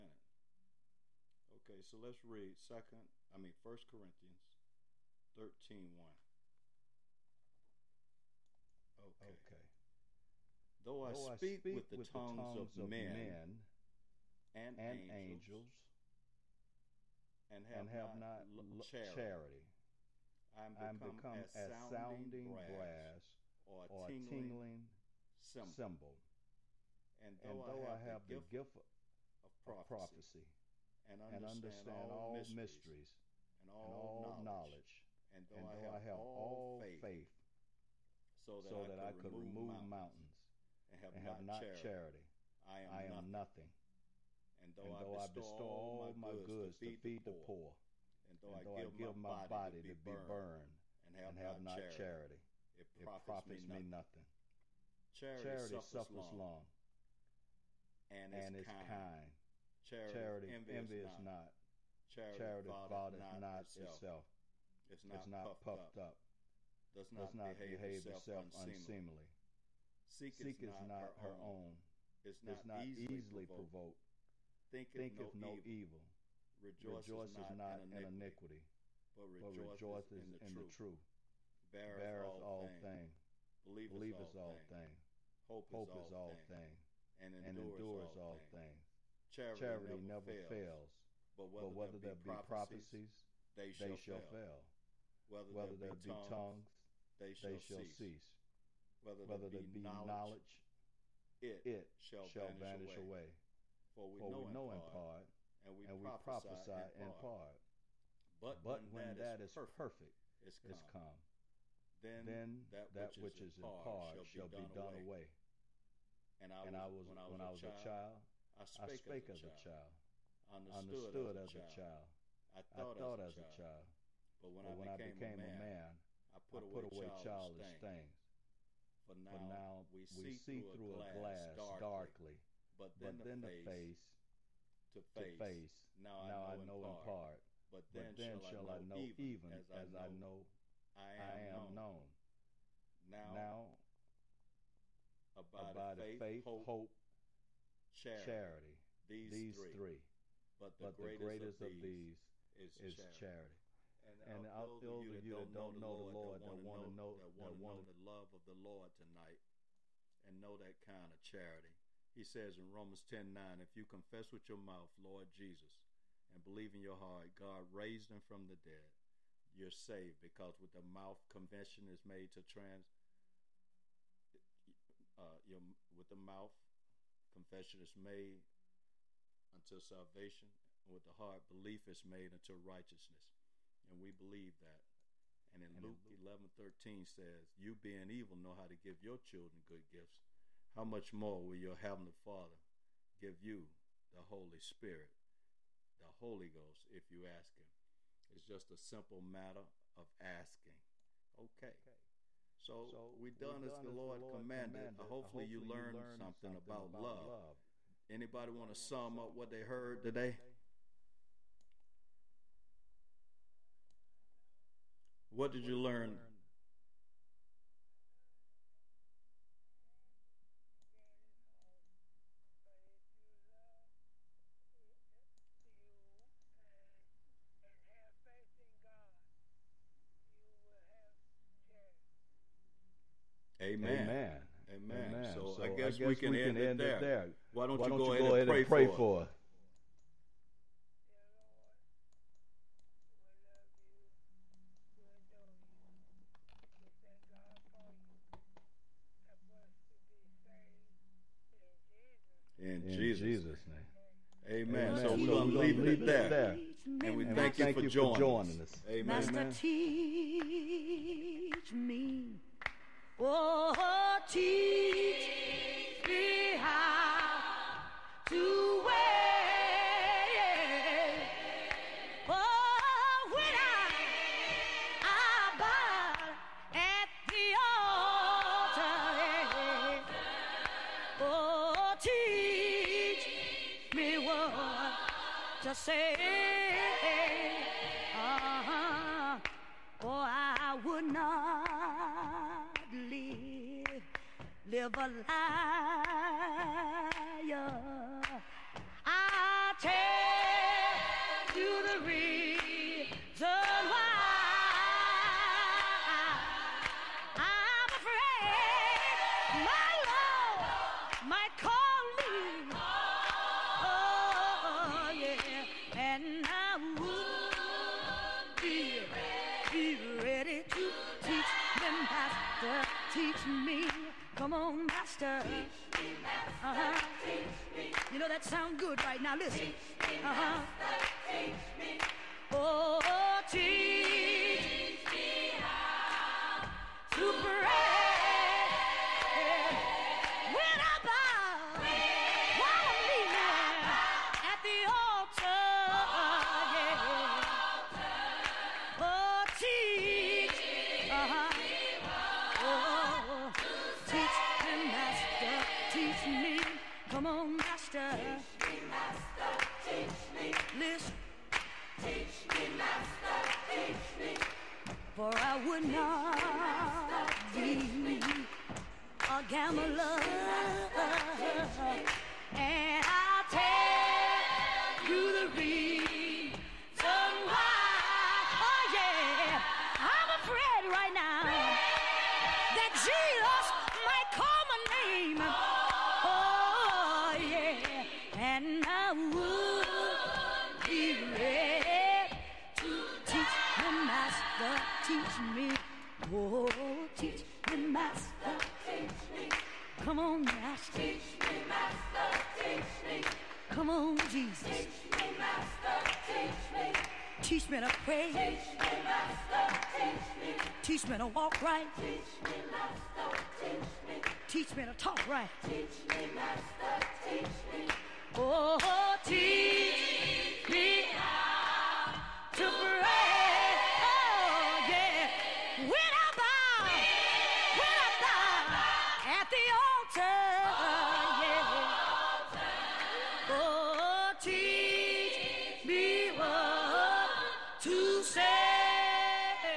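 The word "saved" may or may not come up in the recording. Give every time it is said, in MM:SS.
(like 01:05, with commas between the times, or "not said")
02:49.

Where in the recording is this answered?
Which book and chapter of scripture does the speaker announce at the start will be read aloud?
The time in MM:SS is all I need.
00:03.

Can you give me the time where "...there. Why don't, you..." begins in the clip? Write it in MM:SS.
03:56.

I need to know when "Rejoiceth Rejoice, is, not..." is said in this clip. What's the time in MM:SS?
01:16.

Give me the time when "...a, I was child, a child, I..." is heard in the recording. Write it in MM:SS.
01:57.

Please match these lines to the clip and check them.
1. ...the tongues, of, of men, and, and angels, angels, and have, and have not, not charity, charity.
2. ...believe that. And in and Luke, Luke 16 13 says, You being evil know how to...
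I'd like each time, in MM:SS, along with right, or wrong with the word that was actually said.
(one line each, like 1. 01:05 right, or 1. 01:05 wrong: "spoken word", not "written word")
1. 00:12 right
2. 03:04 wrong: "11", not "16".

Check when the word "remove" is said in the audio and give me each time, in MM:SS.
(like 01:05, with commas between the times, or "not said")
00:39.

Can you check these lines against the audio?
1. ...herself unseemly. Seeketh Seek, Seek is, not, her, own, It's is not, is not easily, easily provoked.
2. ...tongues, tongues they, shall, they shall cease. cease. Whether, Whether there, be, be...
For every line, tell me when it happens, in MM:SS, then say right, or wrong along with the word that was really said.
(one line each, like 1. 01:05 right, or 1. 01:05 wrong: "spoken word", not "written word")
1. 01:08 right
2. 01:36 right.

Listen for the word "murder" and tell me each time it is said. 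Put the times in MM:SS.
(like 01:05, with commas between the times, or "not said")
not said.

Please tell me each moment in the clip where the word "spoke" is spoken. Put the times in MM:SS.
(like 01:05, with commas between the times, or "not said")
not said.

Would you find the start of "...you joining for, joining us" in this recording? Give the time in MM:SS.
04:17.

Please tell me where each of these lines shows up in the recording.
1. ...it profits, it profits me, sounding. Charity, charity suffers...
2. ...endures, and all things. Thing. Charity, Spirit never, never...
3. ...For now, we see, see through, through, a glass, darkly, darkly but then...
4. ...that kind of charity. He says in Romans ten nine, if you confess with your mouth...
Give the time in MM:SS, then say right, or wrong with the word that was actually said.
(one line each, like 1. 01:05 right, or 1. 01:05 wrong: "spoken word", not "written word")
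1. 00:52 wrong: "nothing", not "sounding"
2. 01:27 wrong: "Charity", not "Spirit"
3. 02:09 right
4. 02:40 right.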